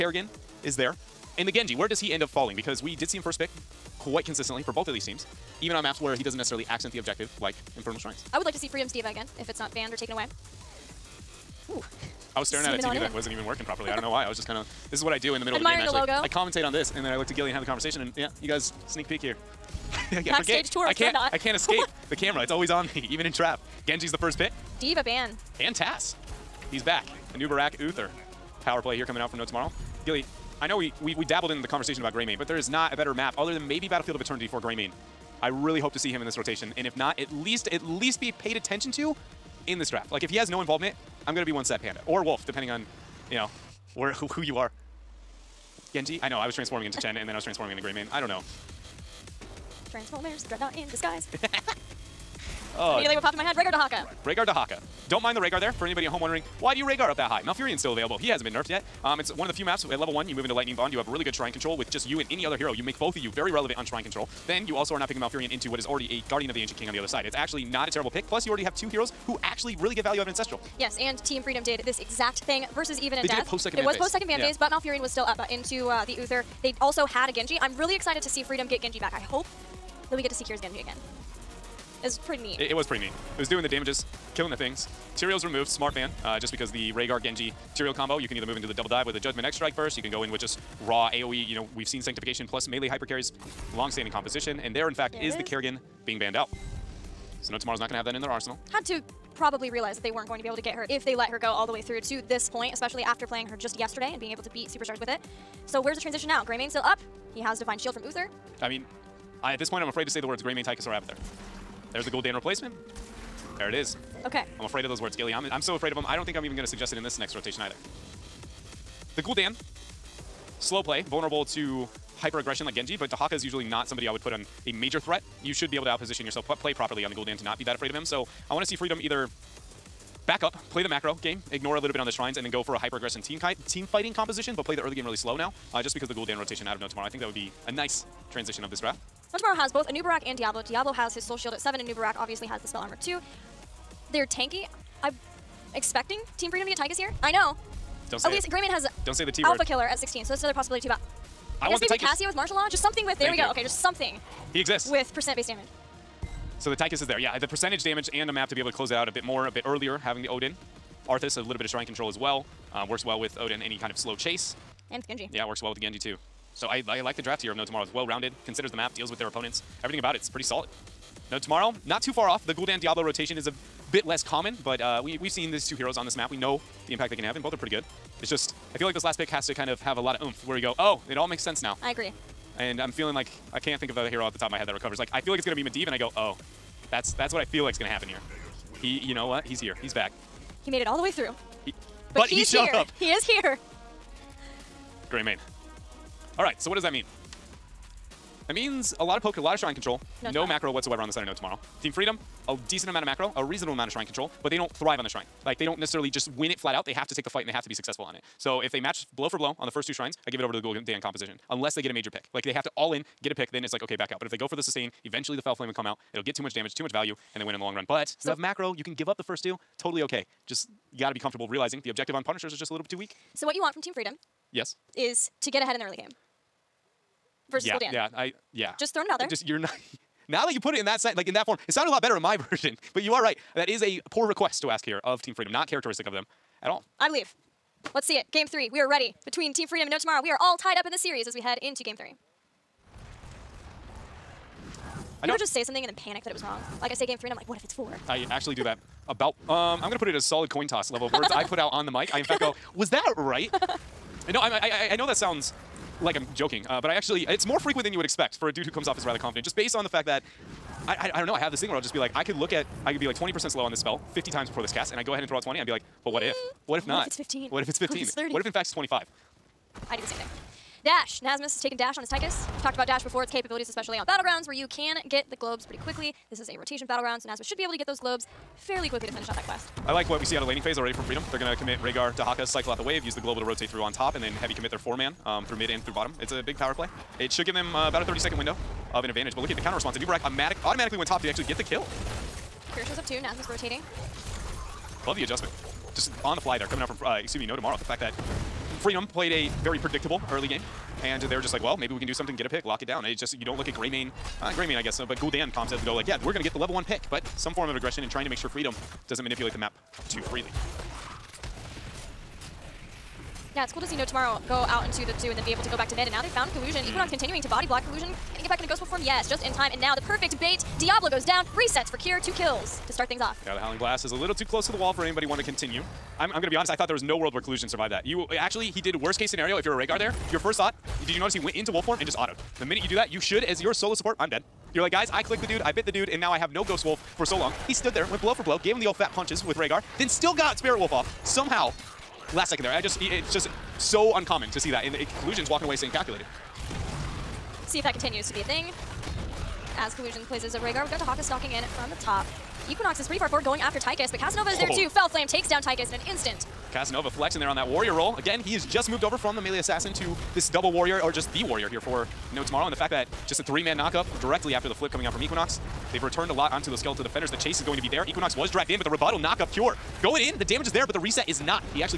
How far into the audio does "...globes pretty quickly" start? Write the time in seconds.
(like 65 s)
275 s.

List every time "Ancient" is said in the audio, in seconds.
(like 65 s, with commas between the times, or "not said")
66 s.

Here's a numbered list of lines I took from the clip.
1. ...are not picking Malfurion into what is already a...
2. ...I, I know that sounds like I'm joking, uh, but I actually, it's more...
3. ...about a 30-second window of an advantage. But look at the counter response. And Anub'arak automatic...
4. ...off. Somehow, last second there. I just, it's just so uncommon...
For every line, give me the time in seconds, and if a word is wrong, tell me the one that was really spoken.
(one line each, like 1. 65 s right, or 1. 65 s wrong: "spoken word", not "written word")
1. 64 s right
2. 254 s right
3. 287 s right
4. 340 s right.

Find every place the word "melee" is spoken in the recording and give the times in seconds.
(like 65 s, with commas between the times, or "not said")
92 s, 359 s.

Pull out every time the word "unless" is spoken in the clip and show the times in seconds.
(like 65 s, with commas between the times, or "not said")
211 s.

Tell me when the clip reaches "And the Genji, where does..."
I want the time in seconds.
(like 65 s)
1 s.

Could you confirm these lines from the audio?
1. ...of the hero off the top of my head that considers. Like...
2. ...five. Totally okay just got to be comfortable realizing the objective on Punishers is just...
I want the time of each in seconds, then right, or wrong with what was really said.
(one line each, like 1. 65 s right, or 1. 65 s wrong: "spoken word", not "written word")
1. 183 s wrong: "recovers", not "considers"
2. 219 s wrong: "two", not "five".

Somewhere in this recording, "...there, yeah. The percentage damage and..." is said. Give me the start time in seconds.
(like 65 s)
157 s.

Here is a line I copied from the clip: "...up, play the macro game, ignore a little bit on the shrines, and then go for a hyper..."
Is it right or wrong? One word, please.
right.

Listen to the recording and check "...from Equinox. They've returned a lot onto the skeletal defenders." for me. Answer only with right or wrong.
right.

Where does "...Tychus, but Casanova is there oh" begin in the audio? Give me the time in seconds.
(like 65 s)
353 s.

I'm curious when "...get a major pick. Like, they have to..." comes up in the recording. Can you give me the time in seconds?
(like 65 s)
211 s.